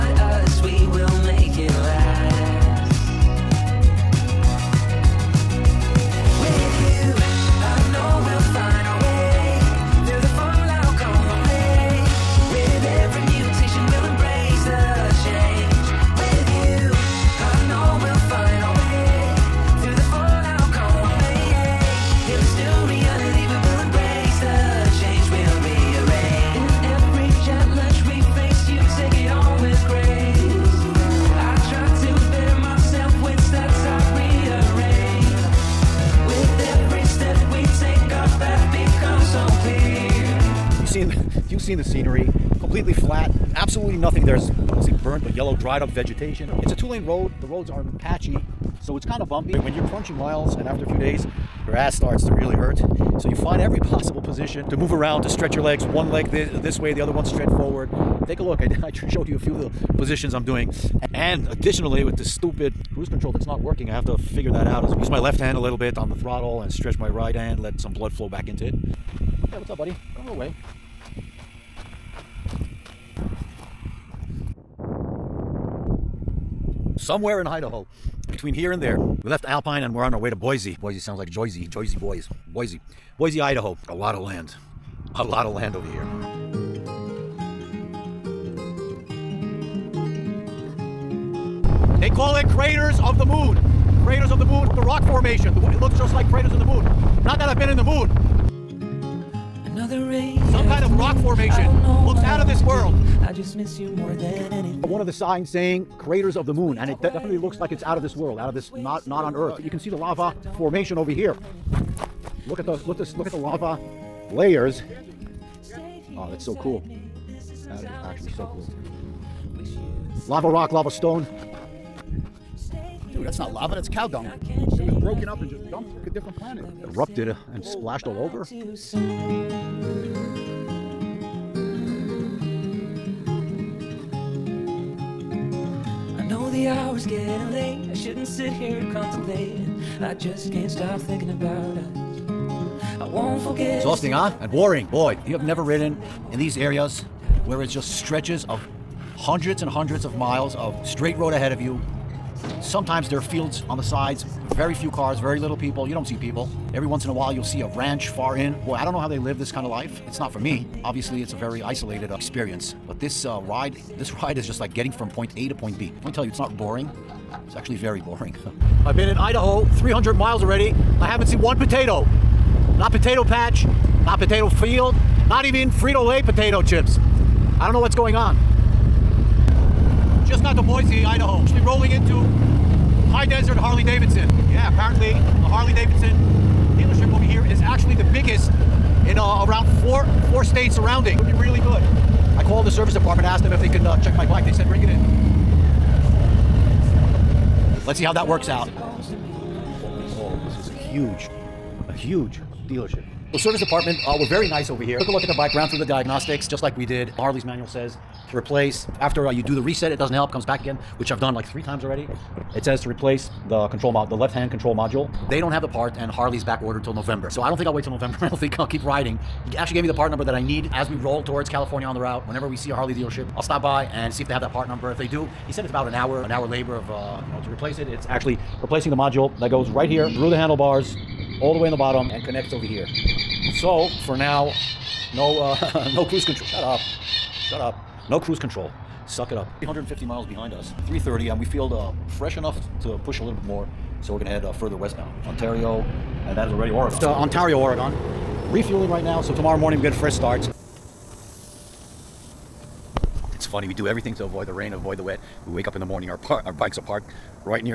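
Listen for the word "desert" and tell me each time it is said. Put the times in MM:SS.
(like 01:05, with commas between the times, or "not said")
03:03.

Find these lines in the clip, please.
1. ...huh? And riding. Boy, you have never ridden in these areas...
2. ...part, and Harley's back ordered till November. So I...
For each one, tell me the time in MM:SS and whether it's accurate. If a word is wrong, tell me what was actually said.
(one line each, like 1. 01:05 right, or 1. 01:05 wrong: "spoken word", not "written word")
1. 02:24 wrong: "boring", not "riding"
2. 03:35 right.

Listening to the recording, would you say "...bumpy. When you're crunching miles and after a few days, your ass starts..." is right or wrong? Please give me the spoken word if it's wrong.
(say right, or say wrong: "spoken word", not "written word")
right.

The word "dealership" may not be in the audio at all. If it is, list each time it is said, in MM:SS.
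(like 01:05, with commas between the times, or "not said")
03:06, 03:22, 03:42.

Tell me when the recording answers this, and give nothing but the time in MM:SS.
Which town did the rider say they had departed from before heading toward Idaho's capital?
01:19.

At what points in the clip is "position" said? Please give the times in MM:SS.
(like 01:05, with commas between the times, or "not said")
00:54, 00:59.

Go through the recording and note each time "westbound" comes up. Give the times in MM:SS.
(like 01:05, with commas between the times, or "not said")
04:04.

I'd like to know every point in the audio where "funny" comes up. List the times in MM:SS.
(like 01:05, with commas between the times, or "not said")
04:13.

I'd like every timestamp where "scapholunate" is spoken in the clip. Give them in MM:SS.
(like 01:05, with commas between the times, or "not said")
not said.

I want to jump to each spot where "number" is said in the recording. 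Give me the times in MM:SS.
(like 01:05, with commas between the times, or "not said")
03:40, 03:44.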